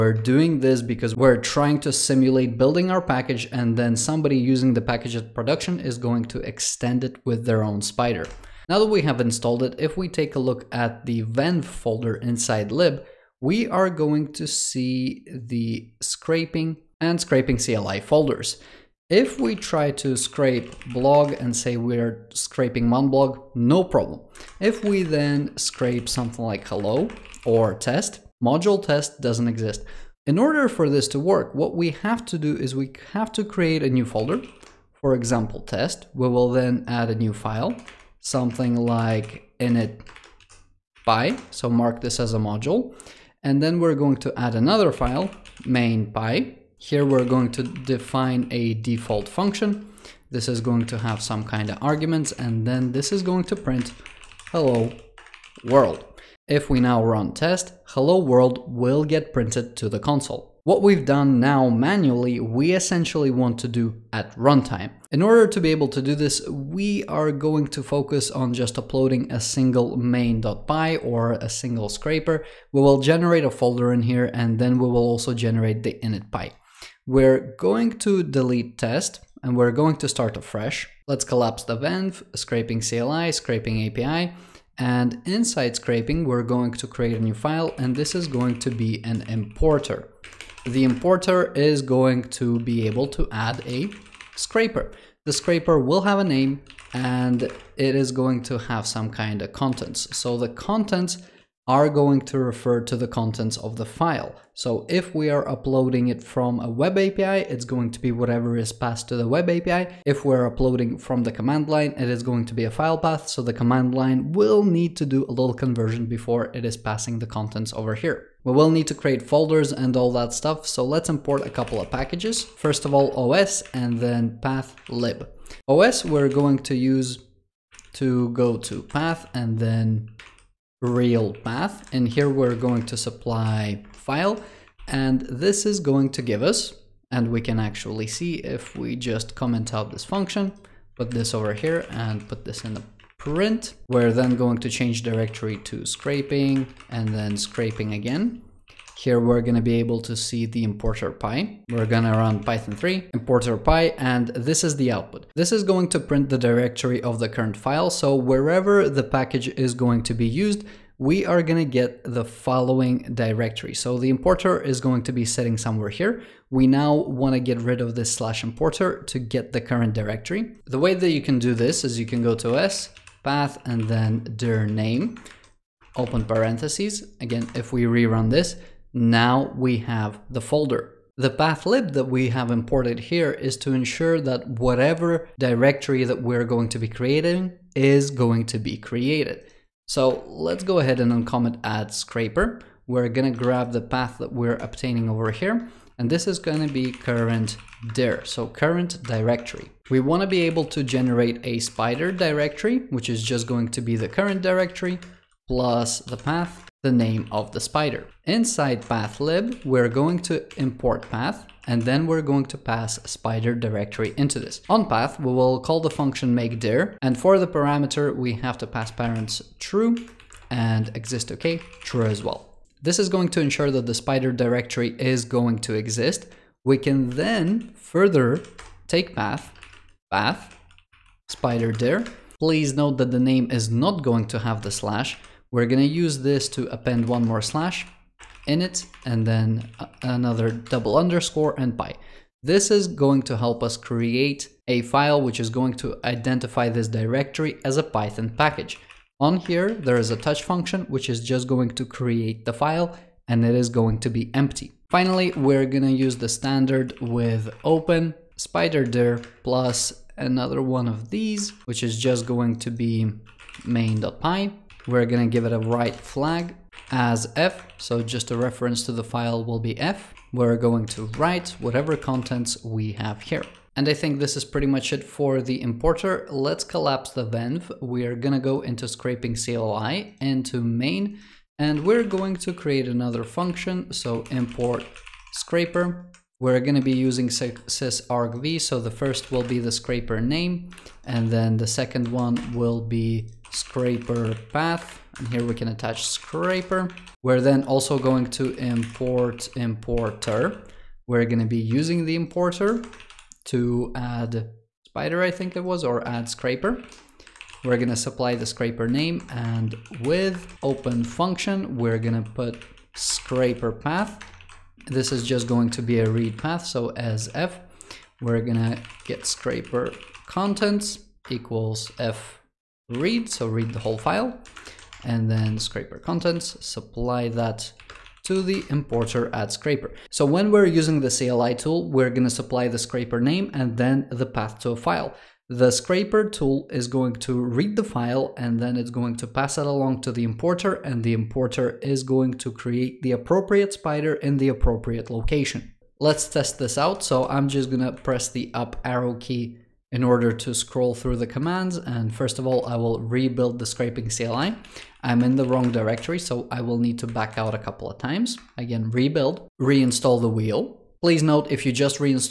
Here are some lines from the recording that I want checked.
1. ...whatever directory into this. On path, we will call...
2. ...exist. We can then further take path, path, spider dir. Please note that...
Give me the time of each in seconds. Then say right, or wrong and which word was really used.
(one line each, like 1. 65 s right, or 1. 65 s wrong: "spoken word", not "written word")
1. 213 s wrong: "spider", not "whatever"
2. 225 s right.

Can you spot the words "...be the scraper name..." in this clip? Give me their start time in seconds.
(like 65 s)
289 s.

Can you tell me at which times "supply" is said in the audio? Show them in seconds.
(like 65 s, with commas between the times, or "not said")
132 s, 307 s, 326 s, 332 s.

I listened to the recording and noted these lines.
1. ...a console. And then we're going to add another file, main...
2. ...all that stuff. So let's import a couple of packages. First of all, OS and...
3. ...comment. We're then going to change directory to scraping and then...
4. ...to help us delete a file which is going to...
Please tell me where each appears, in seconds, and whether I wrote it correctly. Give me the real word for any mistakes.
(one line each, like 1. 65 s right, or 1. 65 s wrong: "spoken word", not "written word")
1. 42 s wrong: "module", not "console"
2. 119 s right
3. 143 s wrong: "print", not "comment"
4. 243 s wrong: "create", not "delete".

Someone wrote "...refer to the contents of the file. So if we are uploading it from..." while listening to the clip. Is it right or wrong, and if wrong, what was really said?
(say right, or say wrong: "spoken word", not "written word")
right.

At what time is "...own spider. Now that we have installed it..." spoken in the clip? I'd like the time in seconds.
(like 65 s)
7 s.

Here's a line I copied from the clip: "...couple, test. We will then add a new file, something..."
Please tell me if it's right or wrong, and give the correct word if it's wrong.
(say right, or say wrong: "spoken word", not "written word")
wrong: "example", not "couple".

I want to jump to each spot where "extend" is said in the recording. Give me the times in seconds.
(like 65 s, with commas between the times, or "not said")
6 s.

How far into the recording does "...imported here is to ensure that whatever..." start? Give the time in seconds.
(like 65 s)
182 s.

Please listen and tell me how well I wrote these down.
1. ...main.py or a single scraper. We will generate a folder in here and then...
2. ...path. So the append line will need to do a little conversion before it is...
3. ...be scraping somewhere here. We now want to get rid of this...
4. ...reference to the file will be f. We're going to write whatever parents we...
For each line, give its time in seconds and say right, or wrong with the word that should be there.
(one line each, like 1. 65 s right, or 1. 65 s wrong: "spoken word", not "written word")
1. 69 s right
2. 112 s wrong: "command", not "append"
3. 165 s wrong: "sitting", not "scraping"
4. 268 s wrong: "contents", not "parents".